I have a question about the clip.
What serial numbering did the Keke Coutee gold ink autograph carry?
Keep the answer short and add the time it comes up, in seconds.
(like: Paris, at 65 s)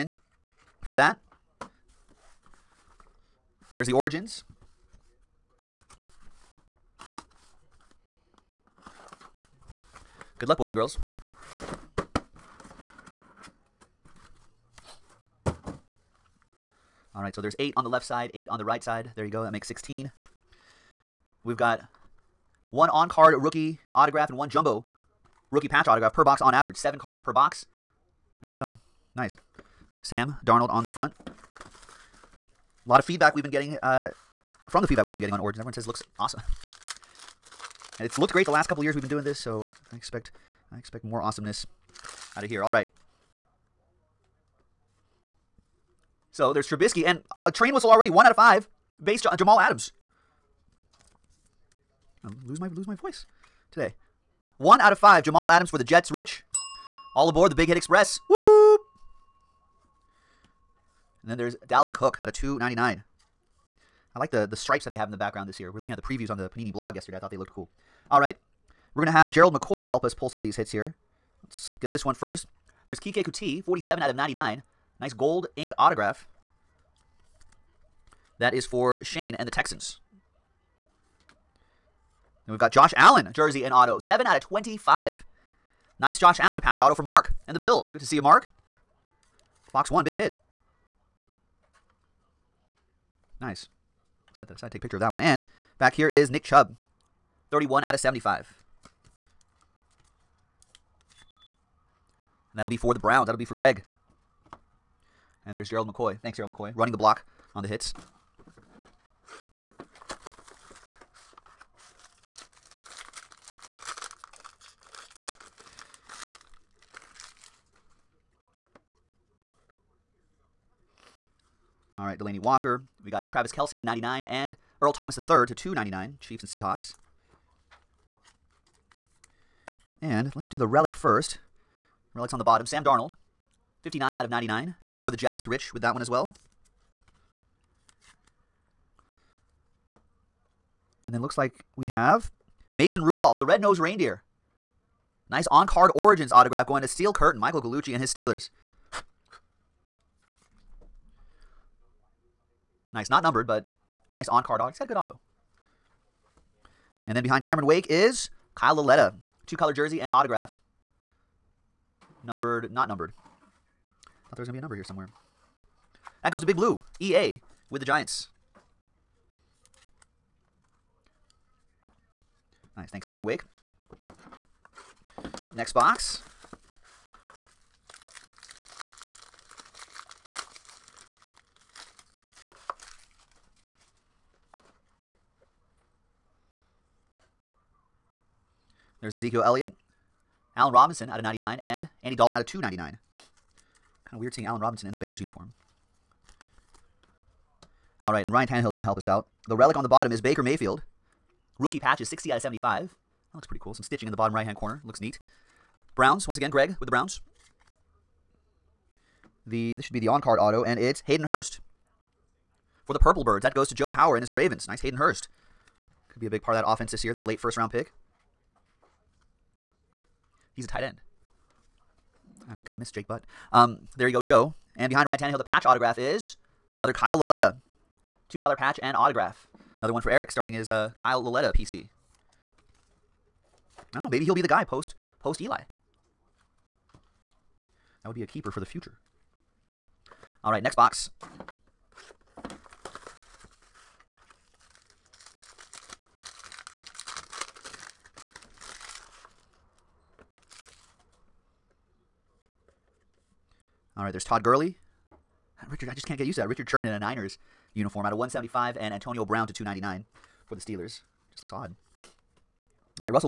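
47/99, at 73 s.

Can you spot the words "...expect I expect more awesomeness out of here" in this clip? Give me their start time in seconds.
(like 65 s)
39 s.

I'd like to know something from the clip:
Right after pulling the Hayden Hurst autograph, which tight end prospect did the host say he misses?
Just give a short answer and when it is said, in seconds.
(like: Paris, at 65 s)
Jake Butt, at 222 s.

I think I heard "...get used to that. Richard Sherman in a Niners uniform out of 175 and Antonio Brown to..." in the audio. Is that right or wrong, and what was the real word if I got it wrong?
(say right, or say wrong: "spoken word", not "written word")
right.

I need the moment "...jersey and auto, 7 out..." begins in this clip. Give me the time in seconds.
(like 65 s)
83 s.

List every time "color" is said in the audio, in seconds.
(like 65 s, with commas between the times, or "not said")
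159 s, 228 s.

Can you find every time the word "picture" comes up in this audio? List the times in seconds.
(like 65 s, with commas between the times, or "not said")
94 s.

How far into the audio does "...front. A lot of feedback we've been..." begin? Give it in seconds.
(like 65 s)
30 s.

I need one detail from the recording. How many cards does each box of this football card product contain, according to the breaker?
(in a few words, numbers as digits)
7.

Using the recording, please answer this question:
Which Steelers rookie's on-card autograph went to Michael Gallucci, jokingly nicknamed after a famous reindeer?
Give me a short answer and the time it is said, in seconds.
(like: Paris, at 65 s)
Mason Rudolph, at 142 s.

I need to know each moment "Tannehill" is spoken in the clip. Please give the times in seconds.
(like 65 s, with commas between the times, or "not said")
198 s, 225 s.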